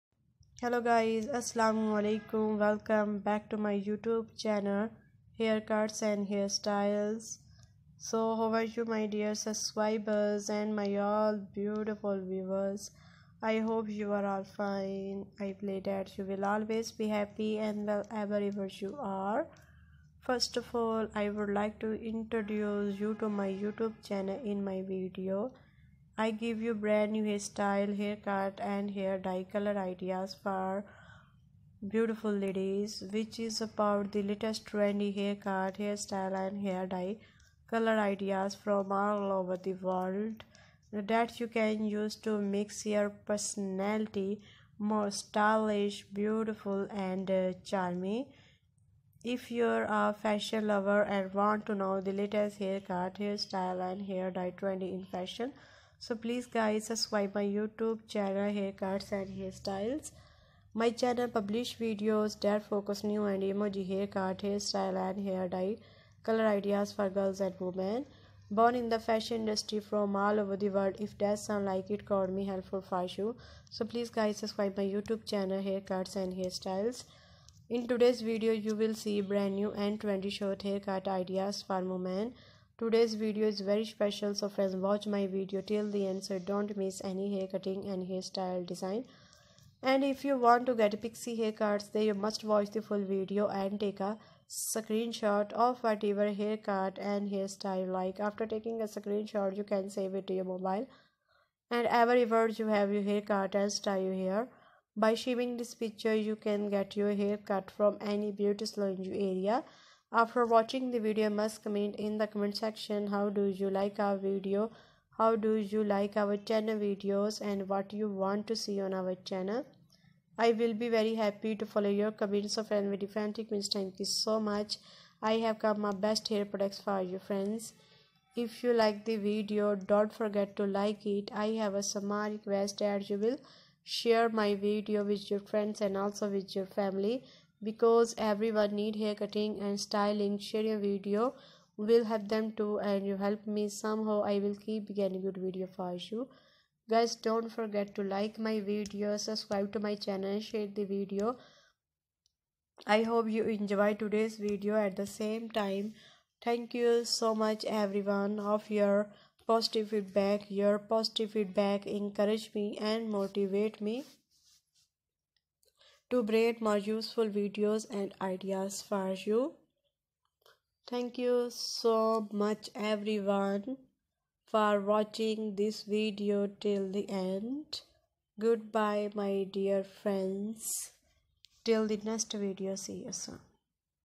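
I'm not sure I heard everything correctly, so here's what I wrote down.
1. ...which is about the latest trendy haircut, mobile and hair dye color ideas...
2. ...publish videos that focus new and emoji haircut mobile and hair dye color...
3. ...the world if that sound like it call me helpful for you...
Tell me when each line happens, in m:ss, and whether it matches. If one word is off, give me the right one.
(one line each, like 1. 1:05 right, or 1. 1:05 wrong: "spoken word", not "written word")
1. 0:33 wrong: "hairstyle", not "mobile"
2. 1:01 wrong: "hairstyle", not "mobile"
3. 1:10 right.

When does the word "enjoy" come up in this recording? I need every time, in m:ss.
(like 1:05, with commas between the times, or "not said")
2:33.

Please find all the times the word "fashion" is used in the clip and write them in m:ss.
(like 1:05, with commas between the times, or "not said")
0:50, 0:55, 1:09.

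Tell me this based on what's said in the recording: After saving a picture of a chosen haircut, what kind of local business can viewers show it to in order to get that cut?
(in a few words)
beauty salon.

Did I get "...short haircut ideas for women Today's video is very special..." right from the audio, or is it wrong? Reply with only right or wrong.
right.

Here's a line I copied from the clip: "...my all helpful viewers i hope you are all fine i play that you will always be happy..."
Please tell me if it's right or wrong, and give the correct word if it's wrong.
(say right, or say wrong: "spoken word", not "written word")
wrong: "beautiful", not "helpful".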